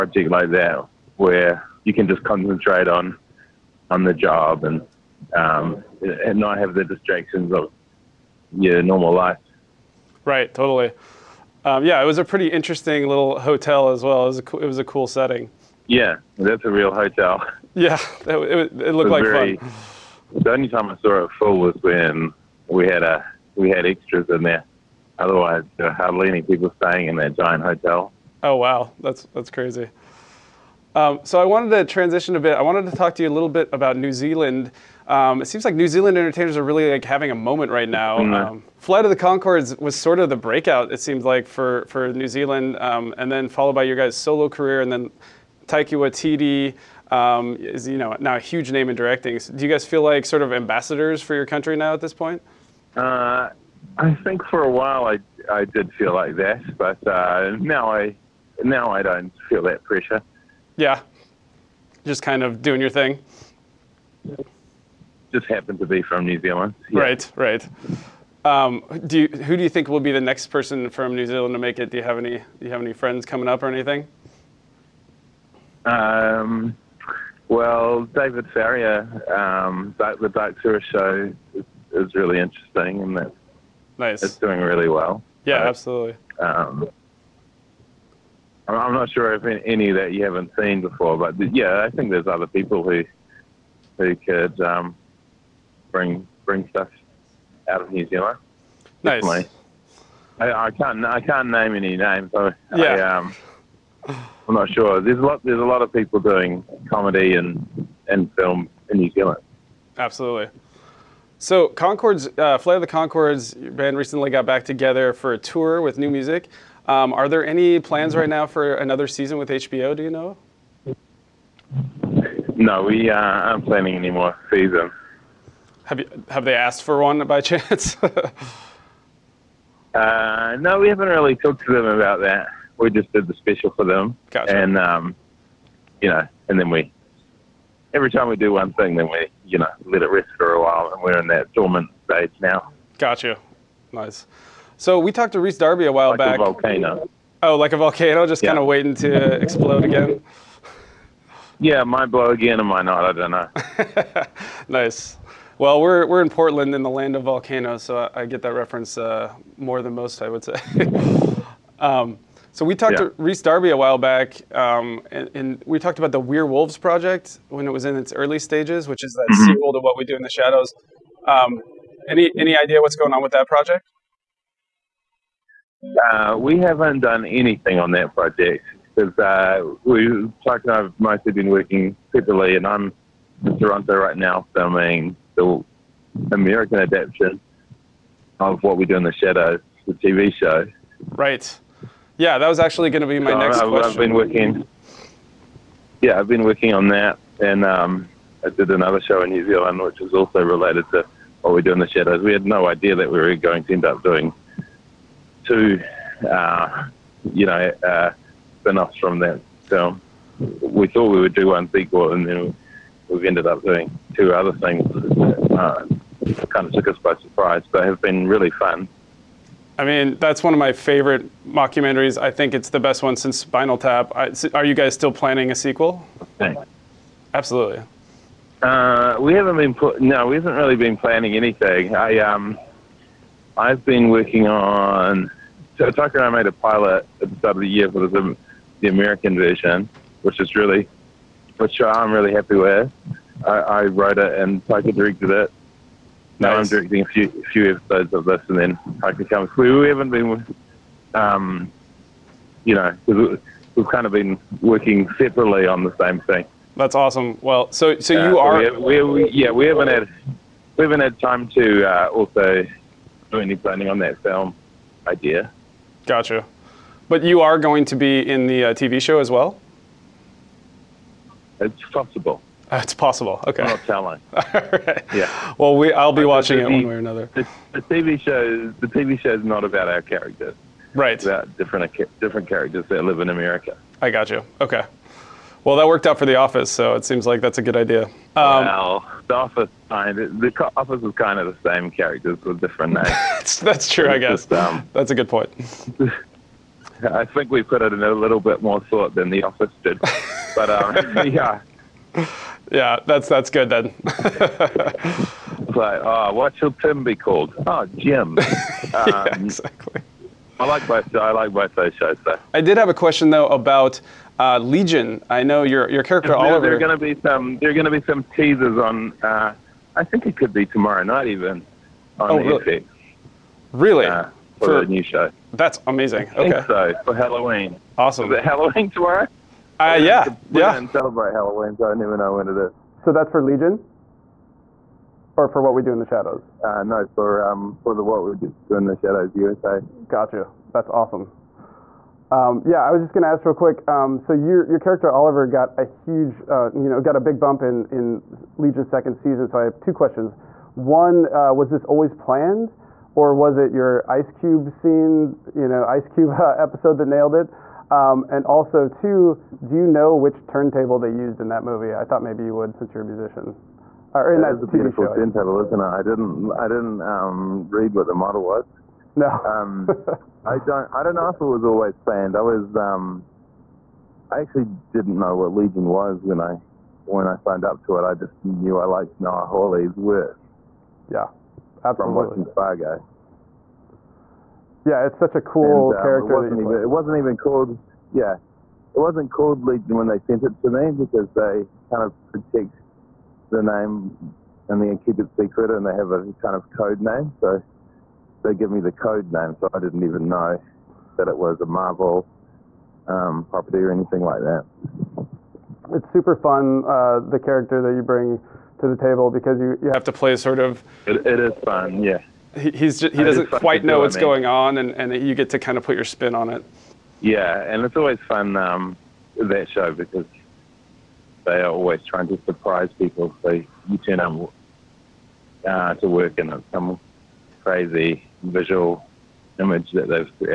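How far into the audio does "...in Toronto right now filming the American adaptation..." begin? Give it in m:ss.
3:03.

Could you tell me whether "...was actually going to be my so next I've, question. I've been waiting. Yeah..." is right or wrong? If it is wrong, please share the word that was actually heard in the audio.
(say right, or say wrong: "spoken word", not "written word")
wrong: "working", not "waiting".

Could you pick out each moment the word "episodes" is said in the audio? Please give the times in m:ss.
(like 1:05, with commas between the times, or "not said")
4:07, 5:56.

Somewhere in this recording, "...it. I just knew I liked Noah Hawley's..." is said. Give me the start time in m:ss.
6:17.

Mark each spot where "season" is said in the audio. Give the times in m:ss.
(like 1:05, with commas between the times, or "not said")
1:59, 2:04, 5:49.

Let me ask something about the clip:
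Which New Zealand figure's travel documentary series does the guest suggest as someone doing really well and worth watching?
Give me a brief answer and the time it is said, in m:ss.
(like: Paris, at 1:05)
David Farrier, at 1:18.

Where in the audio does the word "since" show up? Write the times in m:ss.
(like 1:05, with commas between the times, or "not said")
3:43, 6:02.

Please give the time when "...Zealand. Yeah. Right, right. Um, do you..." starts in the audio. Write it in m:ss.
1:06.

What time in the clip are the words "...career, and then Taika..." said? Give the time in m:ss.
0:44.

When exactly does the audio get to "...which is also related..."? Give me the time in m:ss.
3:19.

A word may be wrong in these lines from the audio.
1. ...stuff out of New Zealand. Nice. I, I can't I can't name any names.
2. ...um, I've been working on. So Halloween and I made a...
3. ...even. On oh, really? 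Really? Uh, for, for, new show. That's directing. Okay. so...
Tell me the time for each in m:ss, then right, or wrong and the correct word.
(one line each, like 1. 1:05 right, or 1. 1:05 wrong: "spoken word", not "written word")
1. 1:36 right
2. 3:52 wrong: "Taika", not "Halloween"
3. 5:21 wrong: "amazing", not "directing".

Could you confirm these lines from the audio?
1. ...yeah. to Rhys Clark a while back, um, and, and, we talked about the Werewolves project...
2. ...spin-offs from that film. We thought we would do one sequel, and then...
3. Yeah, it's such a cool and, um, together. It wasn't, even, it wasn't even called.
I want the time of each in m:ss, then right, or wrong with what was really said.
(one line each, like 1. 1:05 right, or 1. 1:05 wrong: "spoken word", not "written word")
1. 2:42 wrong: "Darby", not "Clark"
2. 3:28 right
3. 6:24 wrong: "character", not "together".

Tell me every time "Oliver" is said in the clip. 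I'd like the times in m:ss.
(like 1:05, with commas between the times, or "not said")
5:16, 5:45.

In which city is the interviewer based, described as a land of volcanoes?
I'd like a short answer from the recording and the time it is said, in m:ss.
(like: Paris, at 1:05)
Portland, at 2:36.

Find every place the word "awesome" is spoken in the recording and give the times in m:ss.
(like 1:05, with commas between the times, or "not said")
4:16, 5:27, 5:40.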